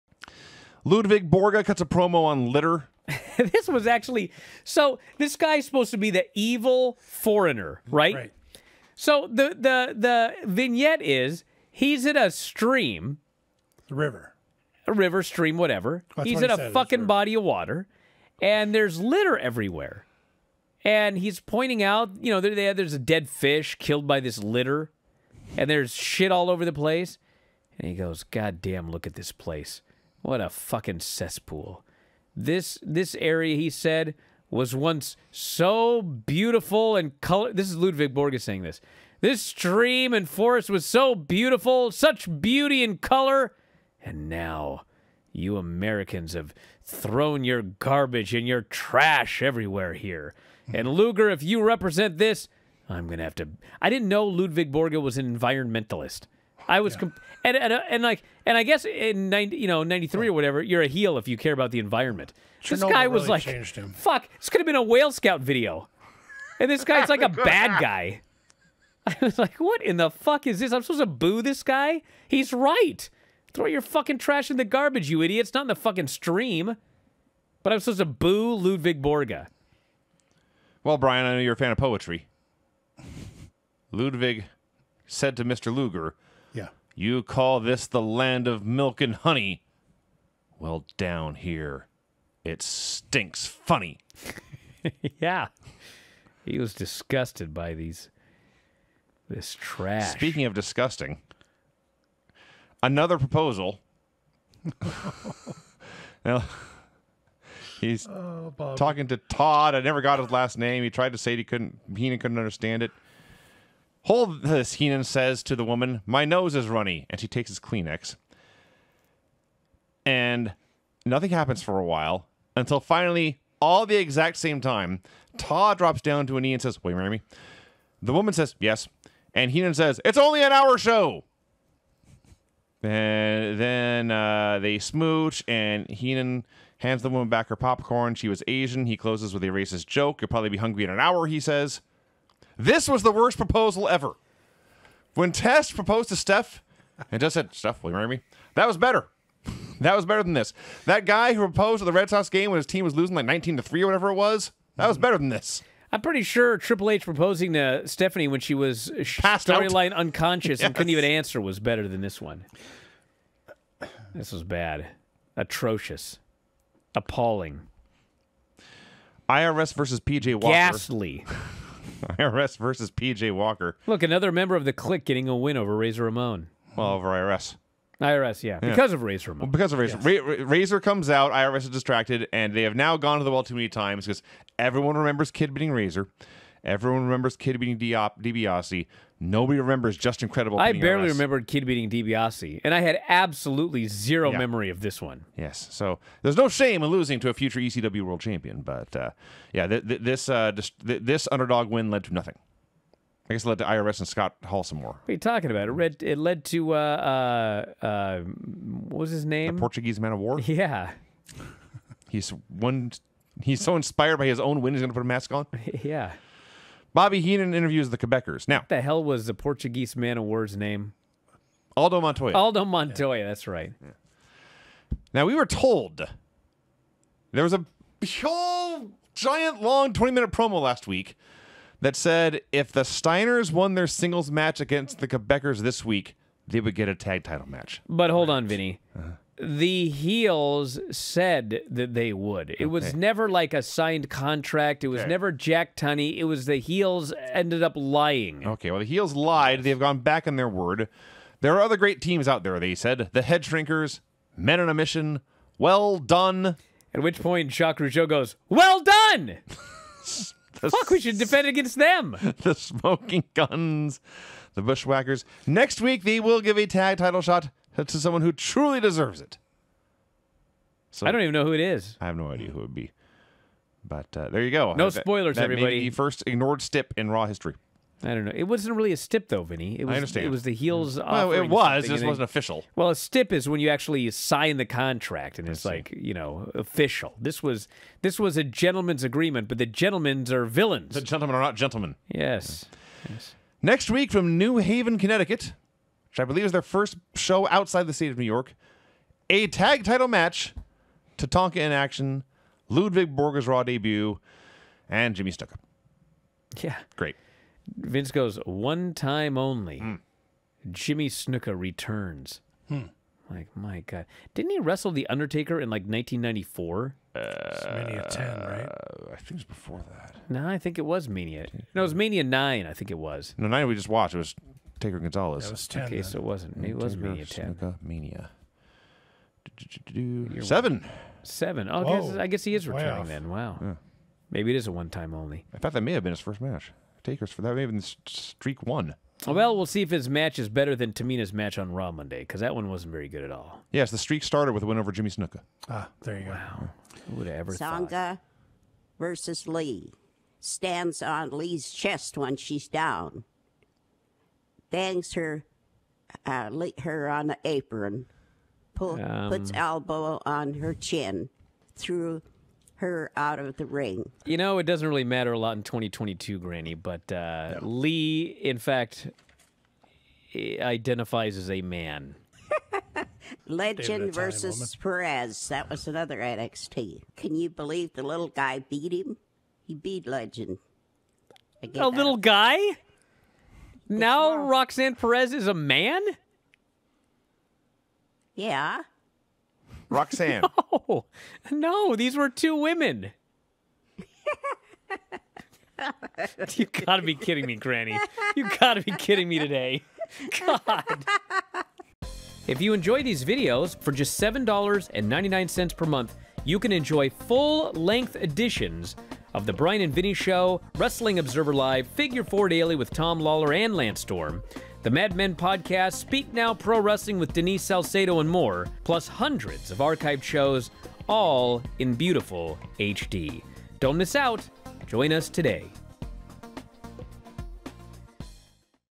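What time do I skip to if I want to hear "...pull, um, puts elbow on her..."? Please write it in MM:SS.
05:58.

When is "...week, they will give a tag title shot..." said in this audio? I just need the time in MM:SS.
04:25.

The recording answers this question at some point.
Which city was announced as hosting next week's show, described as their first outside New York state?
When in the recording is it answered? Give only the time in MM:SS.
04:54.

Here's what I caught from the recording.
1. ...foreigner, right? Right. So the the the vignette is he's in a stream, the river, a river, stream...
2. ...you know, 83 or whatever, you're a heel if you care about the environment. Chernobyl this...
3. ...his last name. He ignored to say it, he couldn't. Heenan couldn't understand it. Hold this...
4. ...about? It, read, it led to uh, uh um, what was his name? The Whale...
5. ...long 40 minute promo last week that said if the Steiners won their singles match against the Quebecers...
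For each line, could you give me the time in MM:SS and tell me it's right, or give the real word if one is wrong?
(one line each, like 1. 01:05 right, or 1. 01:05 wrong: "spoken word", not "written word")
1. 00:07 right
2. 00:59 wrong: "93", not "83"
3. 01:50 wrong: "tried", not "ignored"
4. 03:25 wrong: "Portuguese", not "Whale"
5. 03:49 wrong: "20", not "40".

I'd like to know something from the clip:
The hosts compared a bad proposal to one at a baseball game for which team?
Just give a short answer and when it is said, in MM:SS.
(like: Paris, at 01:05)
Red Sox, at 02:31.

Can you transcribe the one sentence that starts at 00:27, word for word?
And he goes, God damn, look at this place.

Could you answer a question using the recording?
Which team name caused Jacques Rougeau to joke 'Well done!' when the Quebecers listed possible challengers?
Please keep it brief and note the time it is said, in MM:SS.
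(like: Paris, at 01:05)
Well Dunn, at 04:15.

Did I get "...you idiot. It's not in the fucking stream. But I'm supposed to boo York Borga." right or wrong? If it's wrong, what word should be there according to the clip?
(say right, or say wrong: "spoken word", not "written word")
wrong: "Ludvig", not "York".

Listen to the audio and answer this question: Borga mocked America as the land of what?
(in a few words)
milk and honey.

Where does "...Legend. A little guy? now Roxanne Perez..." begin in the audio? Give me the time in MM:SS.
06:20.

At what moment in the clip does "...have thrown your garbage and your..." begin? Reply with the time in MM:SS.
00:46.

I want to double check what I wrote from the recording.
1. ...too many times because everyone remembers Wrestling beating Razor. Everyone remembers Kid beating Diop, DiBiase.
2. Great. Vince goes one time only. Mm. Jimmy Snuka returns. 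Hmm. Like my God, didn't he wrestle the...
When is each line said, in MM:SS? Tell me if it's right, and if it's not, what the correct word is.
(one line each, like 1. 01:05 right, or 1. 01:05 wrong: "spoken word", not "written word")
1. 03:03 wrong: "Kid", not "Wrestling"
2. 05:06 right.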